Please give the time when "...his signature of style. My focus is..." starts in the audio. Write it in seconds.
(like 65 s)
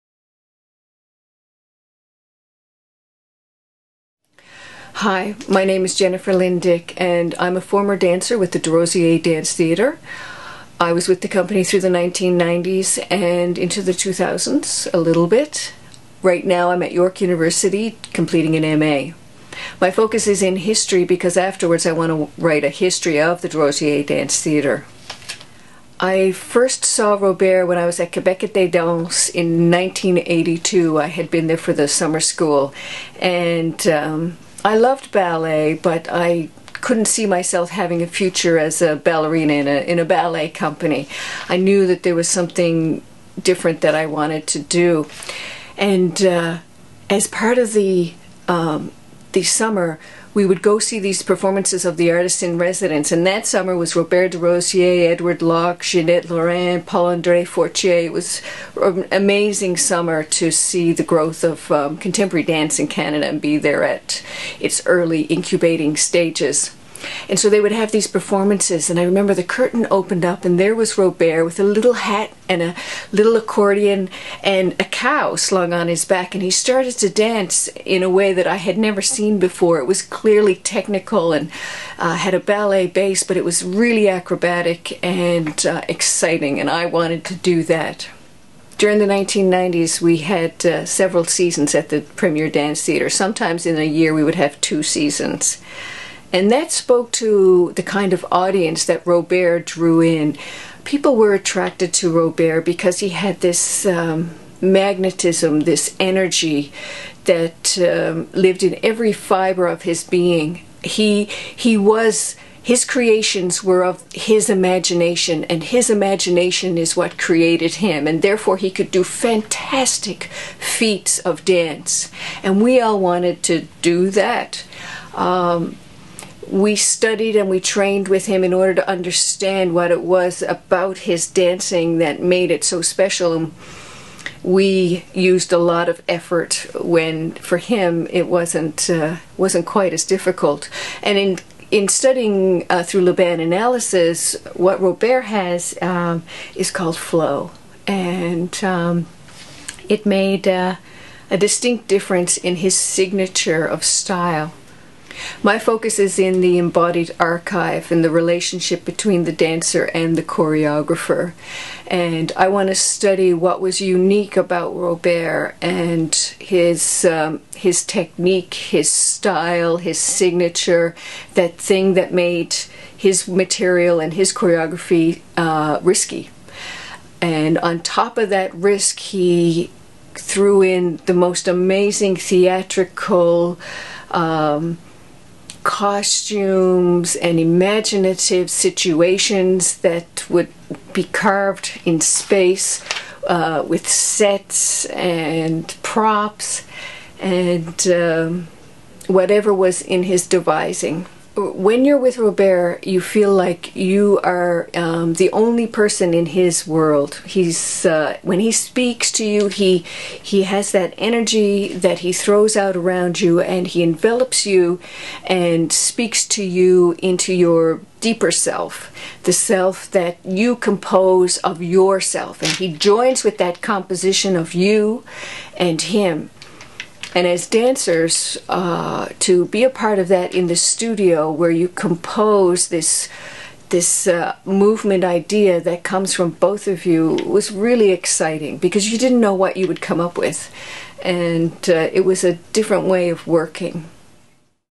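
152 s.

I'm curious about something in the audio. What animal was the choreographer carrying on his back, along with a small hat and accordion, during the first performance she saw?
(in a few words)
cow.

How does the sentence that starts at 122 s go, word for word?
And we all wanted to do that.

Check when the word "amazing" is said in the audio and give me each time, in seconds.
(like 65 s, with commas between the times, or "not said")
59 s, 181 s.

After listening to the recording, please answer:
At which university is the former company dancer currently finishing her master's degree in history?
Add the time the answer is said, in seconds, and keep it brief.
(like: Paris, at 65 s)
York University, at 16 s.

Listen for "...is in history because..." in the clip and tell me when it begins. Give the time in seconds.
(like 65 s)
20 s.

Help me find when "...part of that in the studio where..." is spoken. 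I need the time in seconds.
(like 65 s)
229 s.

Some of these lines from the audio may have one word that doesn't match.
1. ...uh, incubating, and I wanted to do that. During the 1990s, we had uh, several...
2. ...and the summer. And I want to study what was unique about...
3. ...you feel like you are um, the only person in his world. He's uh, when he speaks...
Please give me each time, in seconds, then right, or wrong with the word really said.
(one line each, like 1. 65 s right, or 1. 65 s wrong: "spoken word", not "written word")
1. 85 s wrong: "exciting", not "incubating"
2. 159 s wrong: "choreographer", not "summer"
3. 202 s right.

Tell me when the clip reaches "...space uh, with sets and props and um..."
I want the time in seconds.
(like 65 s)
192 s.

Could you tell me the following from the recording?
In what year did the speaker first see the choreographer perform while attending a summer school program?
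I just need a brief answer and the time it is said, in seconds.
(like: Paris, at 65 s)
1982, at 29 s.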